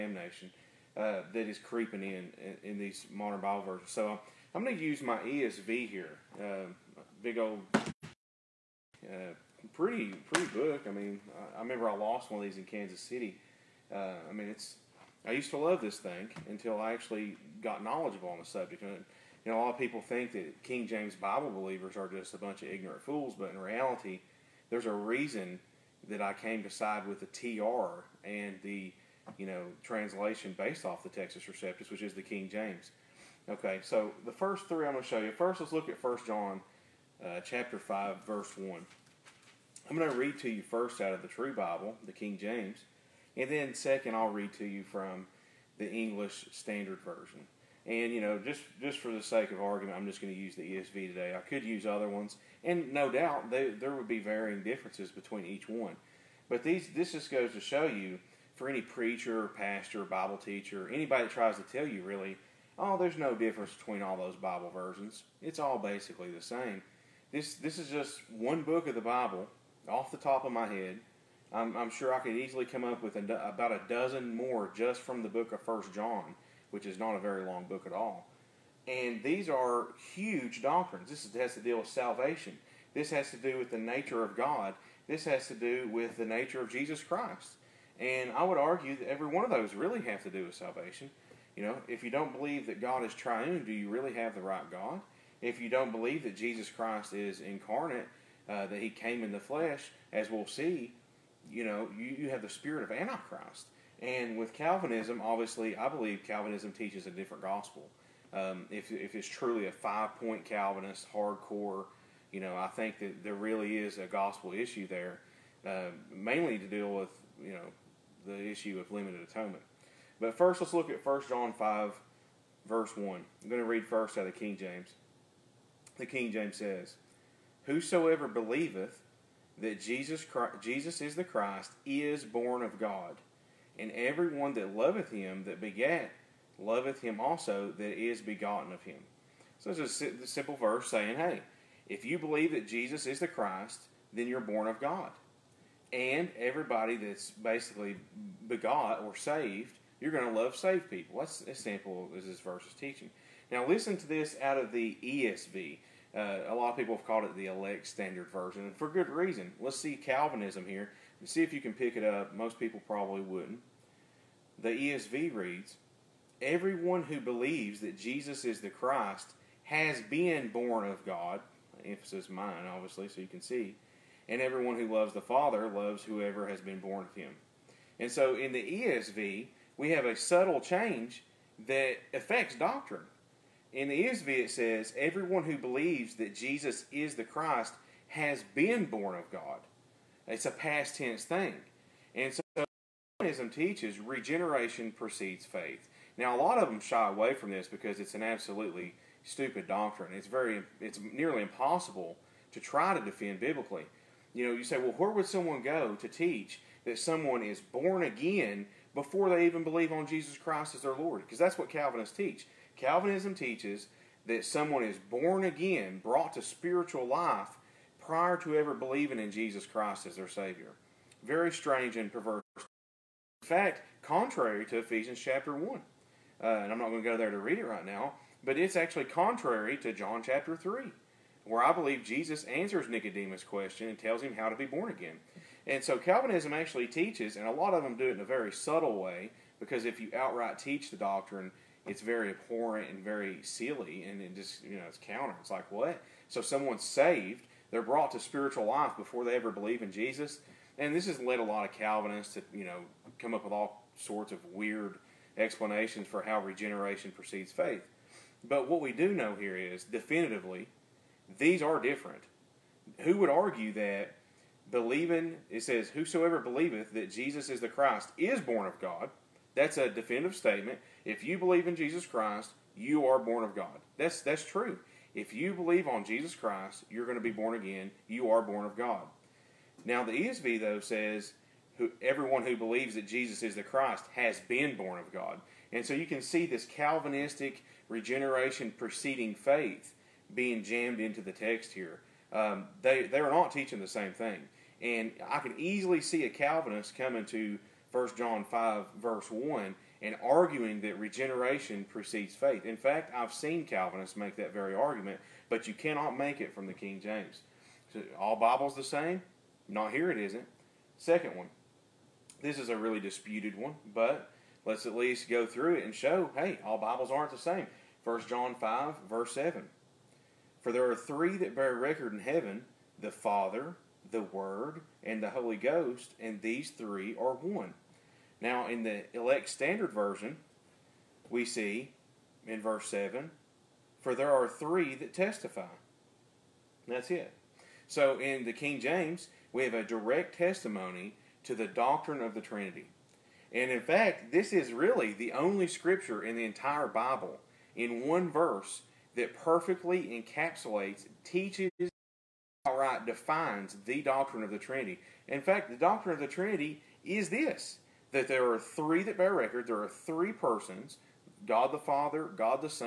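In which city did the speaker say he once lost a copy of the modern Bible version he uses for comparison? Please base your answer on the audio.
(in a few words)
Kansas City.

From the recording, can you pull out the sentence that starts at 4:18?
But what we do know here is definitively these are different.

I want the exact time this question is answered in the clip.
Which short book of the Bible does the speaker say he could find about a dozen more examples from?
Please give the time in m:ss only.
1:15.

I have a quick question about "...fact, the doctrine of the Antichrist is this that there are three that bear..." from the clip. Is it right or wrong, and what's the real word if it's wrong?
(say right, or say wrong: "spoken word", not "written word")
wrong: "Trinity", not "Antichrist".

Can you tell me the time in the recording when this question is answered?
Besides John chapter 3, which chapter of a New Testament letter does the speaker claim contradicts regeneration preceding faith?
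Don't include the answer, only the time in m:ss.
3:44.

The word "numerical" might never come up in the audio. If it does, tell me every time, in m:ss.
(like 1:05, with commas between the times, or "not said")
not said.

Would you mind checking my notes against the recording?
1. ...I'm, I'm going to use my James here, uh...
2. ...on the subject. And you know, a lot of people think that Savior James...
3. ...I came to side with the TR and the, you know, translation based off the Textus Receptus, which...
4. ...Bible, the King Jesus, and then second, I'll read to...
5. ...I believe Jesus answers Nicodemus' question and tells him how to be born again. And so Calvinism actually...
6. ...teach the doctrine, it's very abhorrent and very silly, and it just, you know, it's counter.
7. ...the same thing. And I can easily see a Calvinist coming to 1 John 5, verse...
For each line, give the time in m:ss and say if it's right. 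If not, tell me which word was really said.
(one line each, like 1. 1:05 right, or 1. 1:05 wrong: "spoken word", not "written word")
1. 0:04 wrong: "ESV", not "James"
2. 0:18 wrong: "King", not "Savior"
3. 0:26 right
4. 0:41 wrong: "James", not "Jesus"
5. 3:51 right
6. 4:00 right
7. 4:53 right.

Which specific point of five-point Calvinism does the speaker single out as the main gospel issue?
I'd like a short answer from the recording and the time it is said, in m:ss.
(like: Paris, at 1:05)
limited atonement, at 1:58.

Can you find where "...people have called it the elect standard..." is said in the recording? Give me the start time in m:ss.
2:36.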